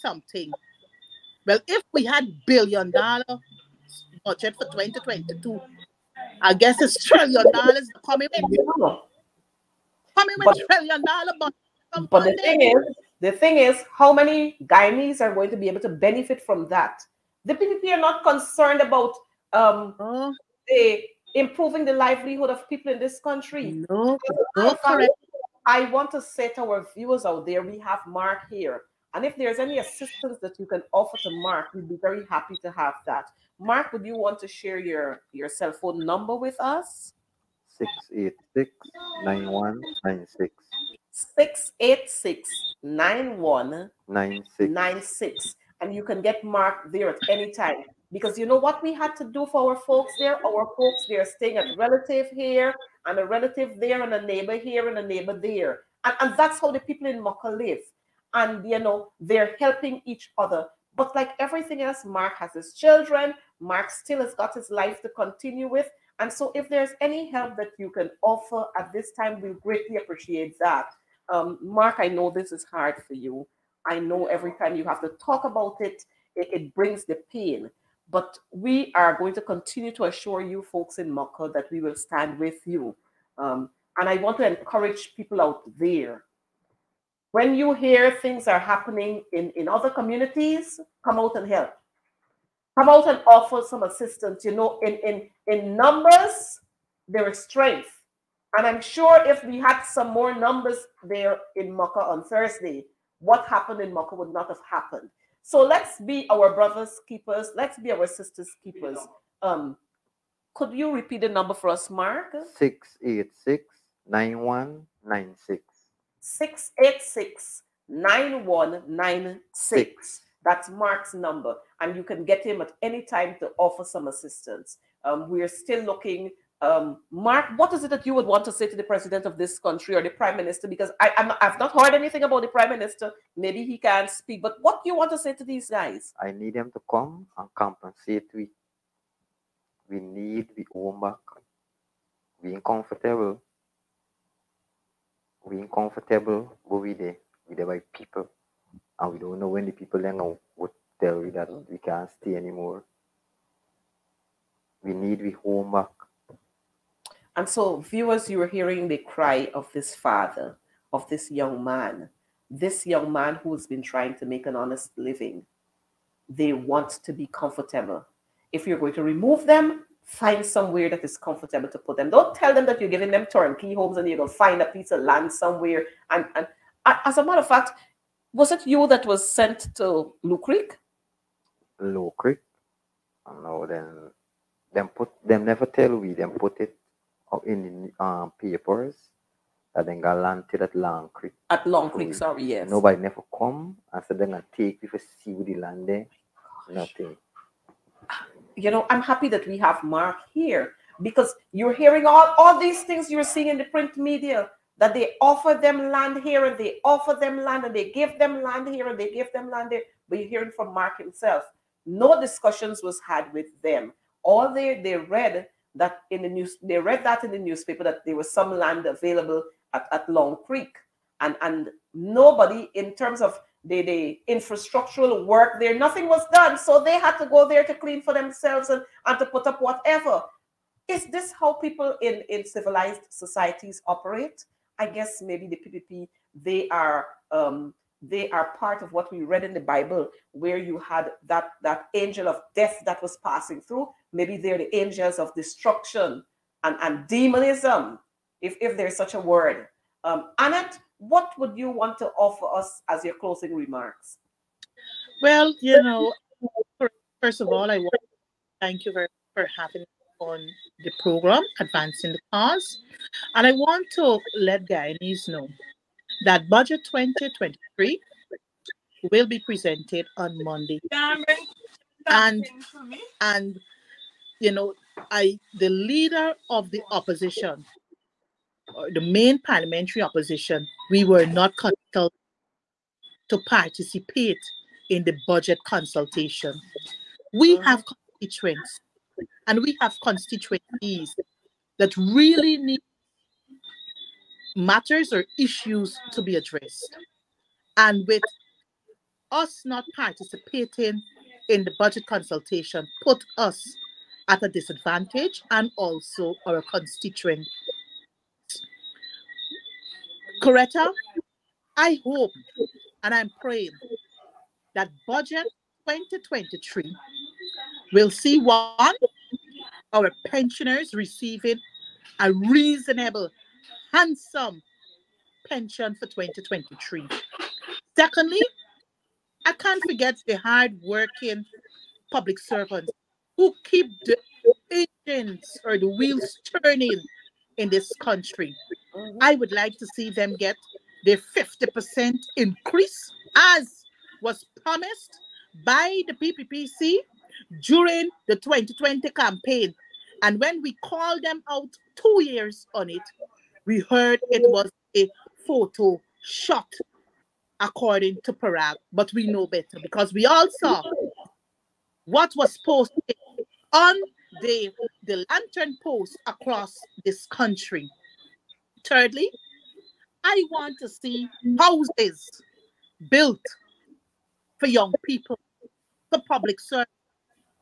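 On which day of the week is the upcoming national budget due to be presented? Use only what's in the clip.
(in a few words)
Monday.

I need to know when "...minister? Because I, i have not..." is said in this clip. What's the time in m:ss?
2:10.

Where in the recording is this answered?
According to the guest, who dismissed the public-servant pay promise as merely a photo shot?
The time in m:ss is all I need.
5:58.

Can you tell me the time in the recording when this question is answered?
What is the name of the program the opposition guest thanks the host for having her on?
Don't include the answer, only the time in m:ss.
4:21.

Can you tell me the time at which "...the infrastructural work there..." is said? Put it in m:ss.
3:43.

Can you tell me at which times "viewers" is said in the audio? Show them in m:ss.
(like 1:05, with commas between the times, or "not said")
0:26, 2:37.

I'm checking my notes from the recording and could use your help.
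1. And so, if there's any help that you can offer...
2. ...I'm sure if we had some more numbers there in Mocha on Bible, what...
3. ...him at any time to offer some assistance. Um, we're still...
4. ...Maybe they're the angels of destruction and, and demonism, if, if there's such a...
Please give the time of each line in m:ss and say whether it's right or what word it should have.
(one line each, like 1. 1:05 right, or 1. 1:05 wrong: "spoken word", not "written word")
1. 1:06 right
2. 1:38 wrong: "Thursday", not "Bible"
3. 2:02 right
4. 4:04 right.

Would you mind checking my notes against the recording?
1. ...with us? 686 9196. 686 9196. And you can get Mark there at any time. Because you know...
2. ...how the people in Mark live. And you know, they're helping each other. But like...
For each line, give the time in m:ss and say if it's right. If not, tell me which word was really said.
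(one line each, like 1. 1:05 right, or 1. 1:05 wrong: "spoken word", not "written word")
1. 0:36 right
2. 0:56 wrong: "Mocha", not "Mark".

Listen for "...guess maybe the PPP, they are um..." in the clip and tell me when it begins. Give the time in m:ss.
3:54.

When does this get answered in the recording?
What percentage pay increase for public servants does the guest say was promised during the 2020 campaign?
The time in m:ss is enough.
5:41.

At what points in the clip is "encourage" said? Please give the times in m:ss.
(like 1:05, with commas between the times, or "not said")
1:24.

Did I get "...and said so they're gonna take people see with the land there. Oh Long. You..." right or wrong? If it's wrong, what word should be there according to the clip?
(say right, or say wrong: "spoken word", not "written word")
wrong: "Nothing", not "Long".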